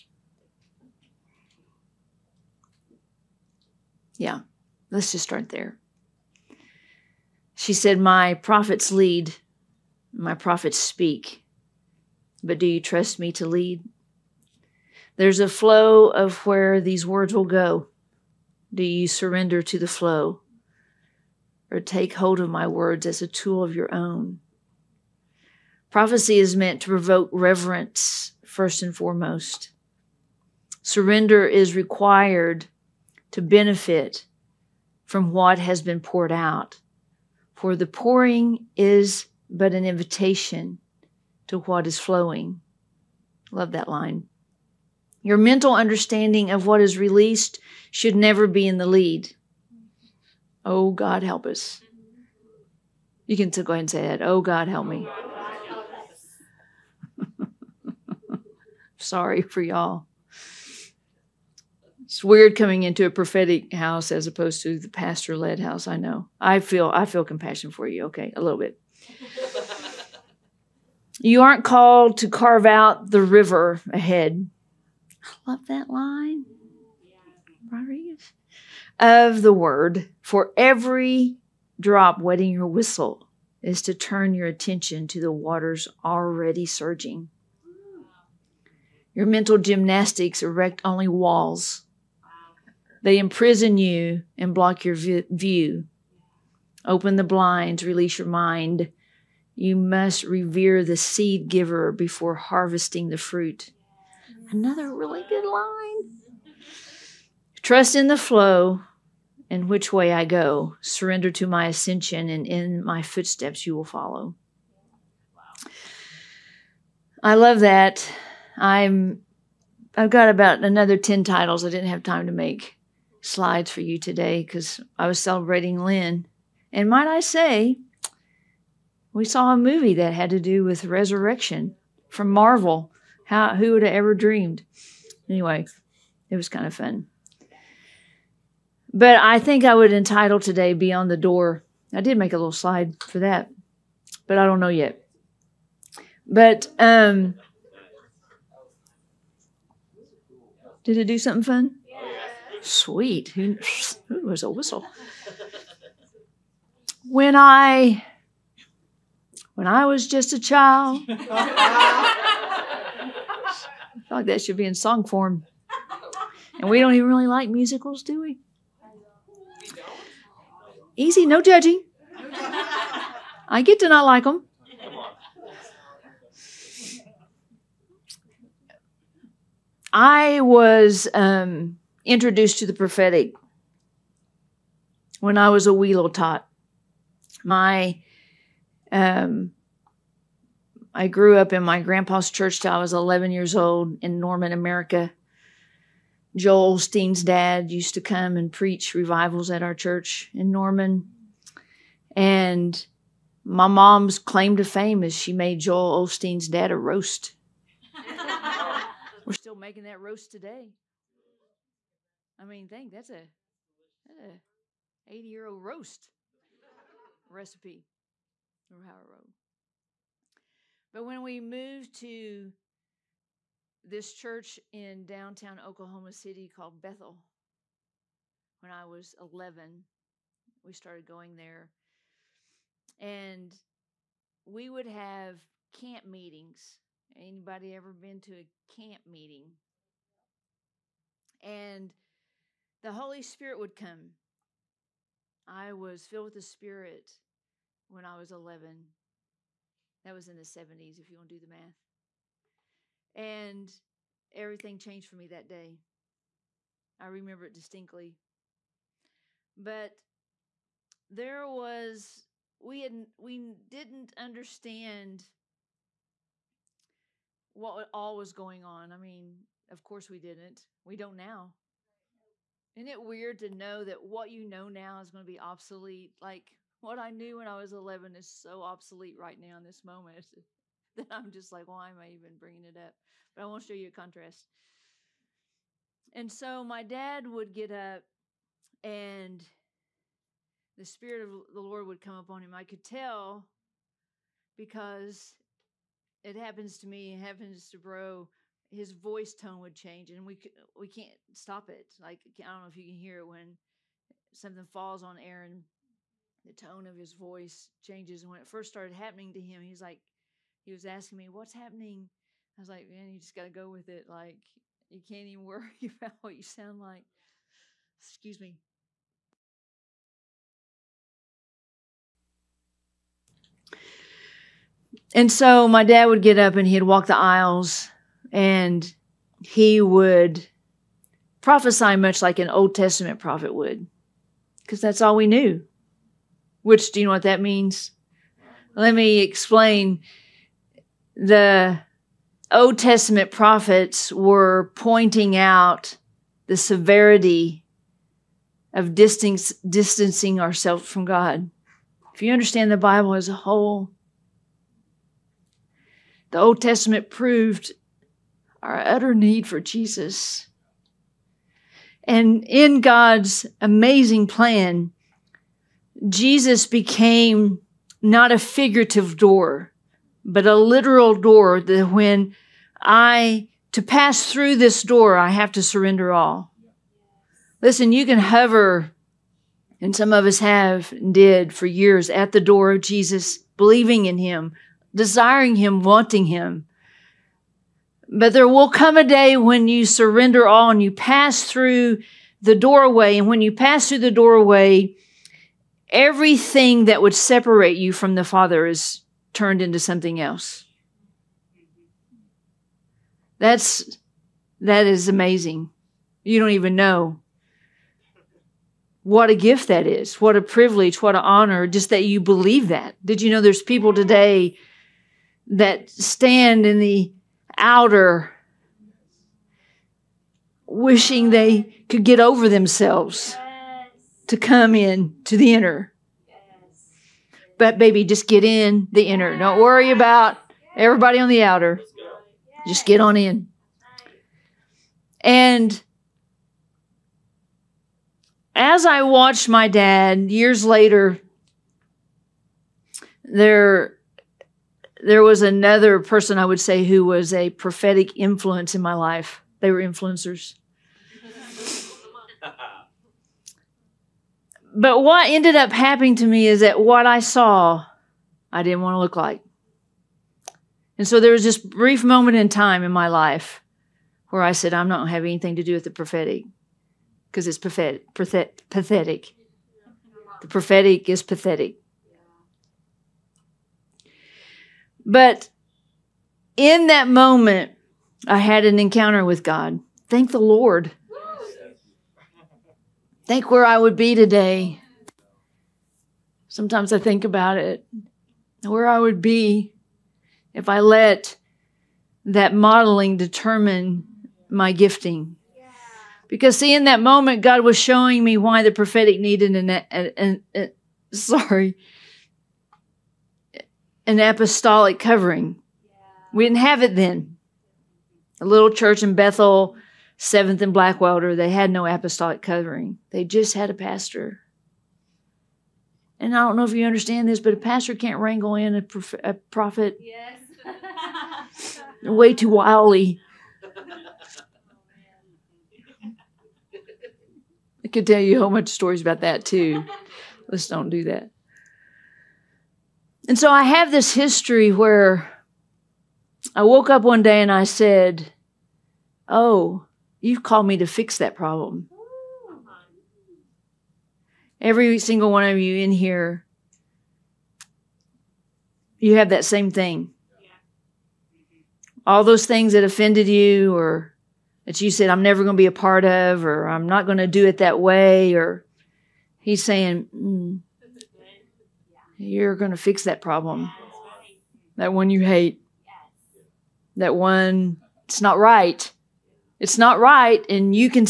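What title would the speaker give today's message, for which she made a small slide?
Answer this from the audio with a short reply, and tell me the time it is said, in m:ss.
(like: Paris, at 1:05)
Beyond the Door, at 2:20.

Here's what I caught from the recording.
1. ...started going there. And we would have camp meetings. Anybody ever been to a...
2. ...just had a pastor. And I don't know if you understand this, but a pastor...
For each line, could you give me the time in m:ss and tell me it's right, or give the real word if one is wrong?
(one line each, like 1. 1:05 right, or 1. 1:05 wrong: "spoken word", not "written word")
1. 3:50 right
2. 8:33 right.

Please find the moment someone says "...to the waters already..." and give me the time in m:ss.
1:25.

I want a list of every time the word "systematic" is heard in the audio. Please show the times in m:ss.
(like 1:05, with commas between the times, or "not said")
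not said.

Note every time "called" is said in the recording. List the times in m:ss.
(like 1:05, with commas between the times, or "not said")
1:11, 3:46, 9:00.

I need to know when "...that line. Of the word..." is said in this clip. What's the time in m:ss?
1:15.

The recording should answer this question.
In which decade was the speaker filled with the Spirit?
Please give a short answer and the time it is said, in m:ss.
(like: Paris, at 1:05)
the 70s, at 4:10.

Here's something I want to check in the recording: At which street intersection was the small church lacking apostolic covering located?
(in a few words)
Seventh and Blackwelder.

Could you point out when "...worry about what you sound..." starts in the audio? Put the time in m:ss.
5:15.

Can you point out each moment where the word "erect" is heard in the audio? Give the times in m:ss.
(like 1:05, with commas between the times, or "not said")
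1:30.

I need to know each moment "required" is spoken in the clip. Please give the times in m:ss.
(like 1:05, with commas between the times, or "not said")
0:31.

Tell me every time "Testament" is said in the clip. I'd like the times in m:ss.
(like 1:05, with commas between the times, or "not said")
5:32, 5:42, 5:56.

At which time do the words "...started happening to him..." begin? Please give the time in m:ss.
5:08.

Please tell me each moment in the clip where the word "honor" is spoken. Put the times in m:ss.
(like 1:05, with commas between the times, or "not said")
6:51.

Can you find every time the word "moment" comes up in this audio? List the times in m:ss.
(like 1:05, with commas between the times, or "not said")
4:39, 7:42, 7:57, 8:17.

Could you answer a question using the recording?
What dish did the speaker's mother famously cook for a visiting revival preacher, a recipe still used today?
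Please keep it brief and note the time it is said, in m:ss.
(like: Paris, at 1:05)
a roast, at 3:26.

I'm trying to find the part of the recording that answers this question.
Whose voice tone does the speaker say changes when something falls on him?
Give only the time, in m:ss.
5:05.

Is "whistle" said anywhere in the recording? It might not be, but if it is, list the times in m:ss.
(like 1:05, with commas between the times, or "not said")
1:22, 2:34.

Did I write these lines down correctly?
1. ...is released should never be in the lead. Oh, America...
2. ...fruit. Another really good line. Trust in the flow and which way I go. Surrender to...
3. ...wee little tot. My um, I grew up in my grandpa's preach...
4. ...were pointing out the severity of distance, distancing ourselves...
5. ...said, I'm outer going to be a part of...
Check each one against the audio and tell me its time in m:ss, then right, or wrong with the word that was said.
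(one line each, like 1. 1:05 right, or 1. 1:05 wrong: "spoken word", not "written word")
1. 0:46 wrong: "God", not "America"
2. 1:43 right
3. 3:05 wrong: "church", not "preach"
4. 5:44 right
5. 9:14 wrong: "never", not "outer".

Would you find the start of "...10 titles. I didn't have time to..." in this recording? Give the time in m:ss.
2:00.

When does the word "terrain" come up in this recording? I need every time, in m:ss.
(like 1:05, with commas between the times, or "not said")
not said.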